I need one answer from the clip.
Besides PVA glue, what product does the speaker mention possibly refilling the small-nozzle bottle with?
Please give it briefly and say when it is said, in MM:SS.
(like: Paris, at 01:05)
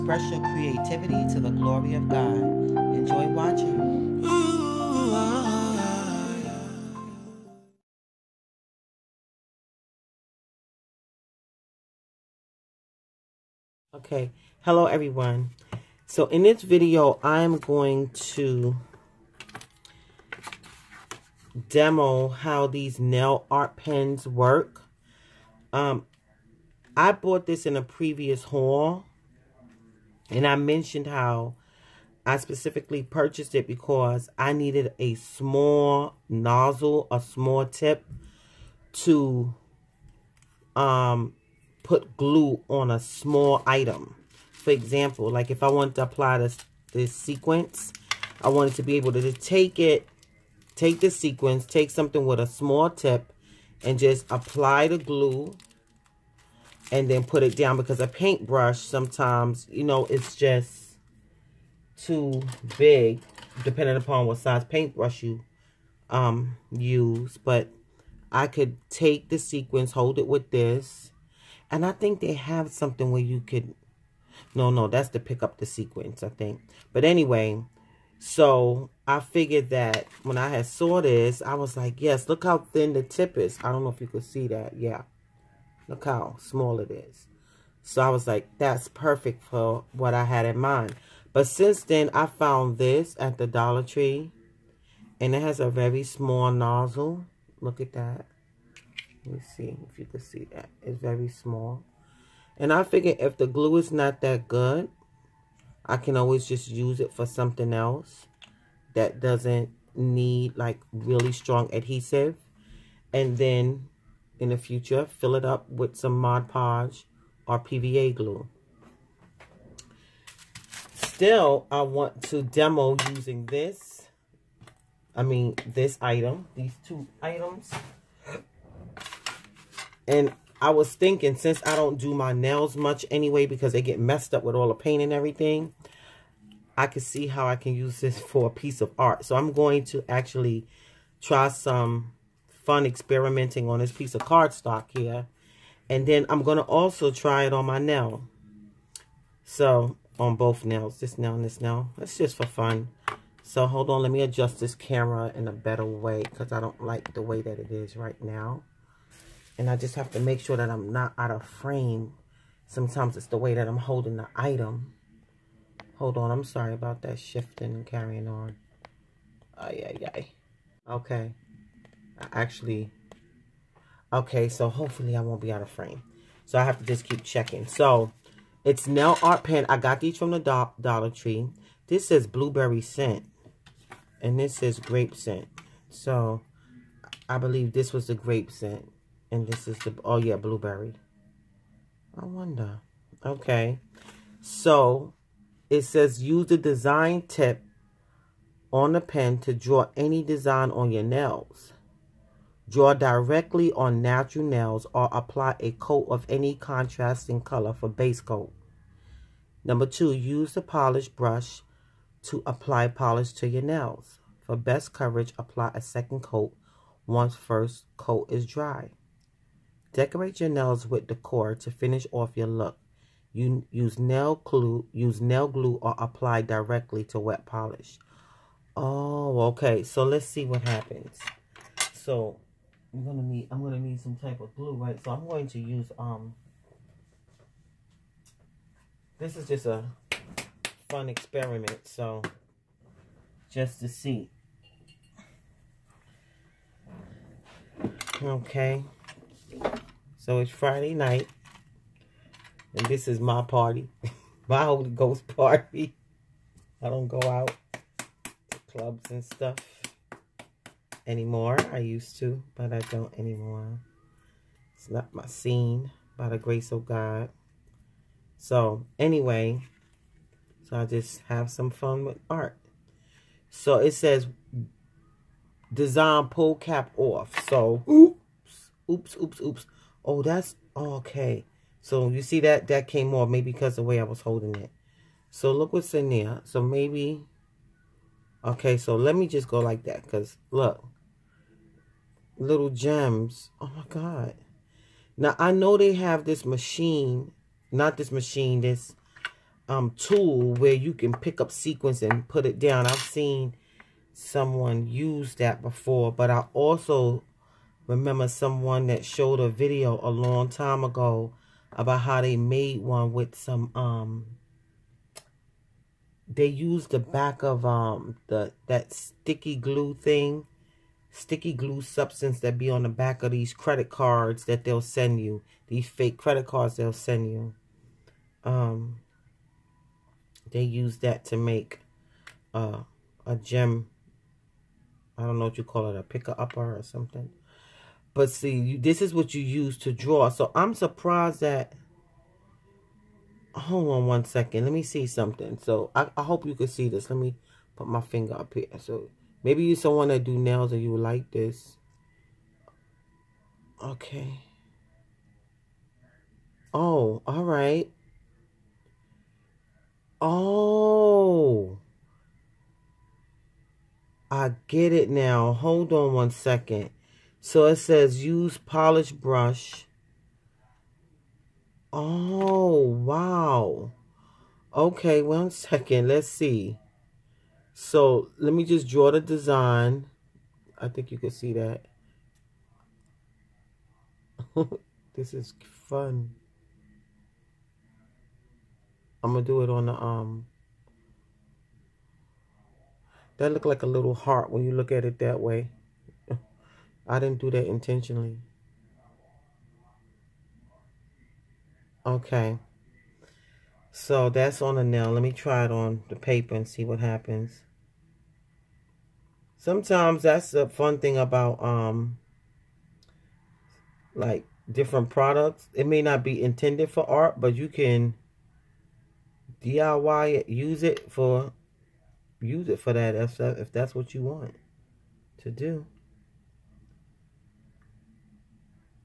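Mod Podge, at 01:56.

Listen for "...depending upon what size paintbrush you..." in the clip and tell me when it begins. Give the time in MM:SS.
01:03.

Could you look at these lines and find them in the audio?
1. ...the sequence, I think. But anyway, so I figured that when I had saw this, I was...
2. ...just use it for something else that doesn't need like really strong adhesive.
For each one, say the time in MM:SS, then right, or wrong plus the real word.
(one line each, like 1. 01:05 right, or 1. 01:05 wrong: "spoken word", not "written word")
1. 01:15 right
2. 01:46 right.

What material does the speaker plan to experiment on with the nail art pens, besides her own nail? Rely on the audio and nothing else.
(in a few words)
cardstock.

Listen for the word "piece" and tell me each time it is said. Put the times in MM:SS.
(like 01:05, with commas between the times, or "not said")
02:18, 02:23.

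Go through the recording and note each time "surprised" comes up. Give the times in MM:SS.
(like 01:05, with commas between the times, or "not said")
05:40.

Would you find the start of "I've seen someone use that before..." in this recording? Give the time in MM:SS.
05:02.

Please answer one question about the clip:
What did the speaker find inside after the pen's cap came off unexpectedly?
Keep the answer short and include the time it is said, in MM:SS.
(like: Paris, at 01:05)
little gems, at 04:52.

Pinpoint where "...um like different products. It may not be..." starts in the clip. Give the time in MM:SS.
06:51.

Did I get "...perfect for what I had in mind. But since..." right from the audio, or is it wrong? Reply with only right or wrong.
right.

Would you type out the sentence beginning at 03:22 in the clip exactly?
Draw directly on natural nails or apply a coat of any contrasting color for base coat.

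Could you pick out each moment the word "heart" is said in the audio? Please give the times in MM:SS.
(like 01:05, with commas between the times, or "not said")
06:34.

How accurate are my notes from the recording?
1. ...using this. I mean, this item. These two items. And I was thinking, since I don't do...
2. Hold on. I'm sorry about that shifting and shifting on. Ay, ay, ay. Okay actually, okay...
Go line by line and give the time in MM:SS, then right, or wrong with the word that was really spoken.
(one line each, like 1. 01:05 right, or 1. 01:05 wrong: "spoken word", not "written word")
1. 02:03 right
2. 02:45 wrong: "carrying", not "shifting".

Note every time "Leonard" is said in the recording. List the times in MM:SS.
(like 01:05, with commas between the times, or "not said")
not said.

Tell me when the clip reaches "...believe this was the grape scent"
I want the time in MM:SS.
03:07.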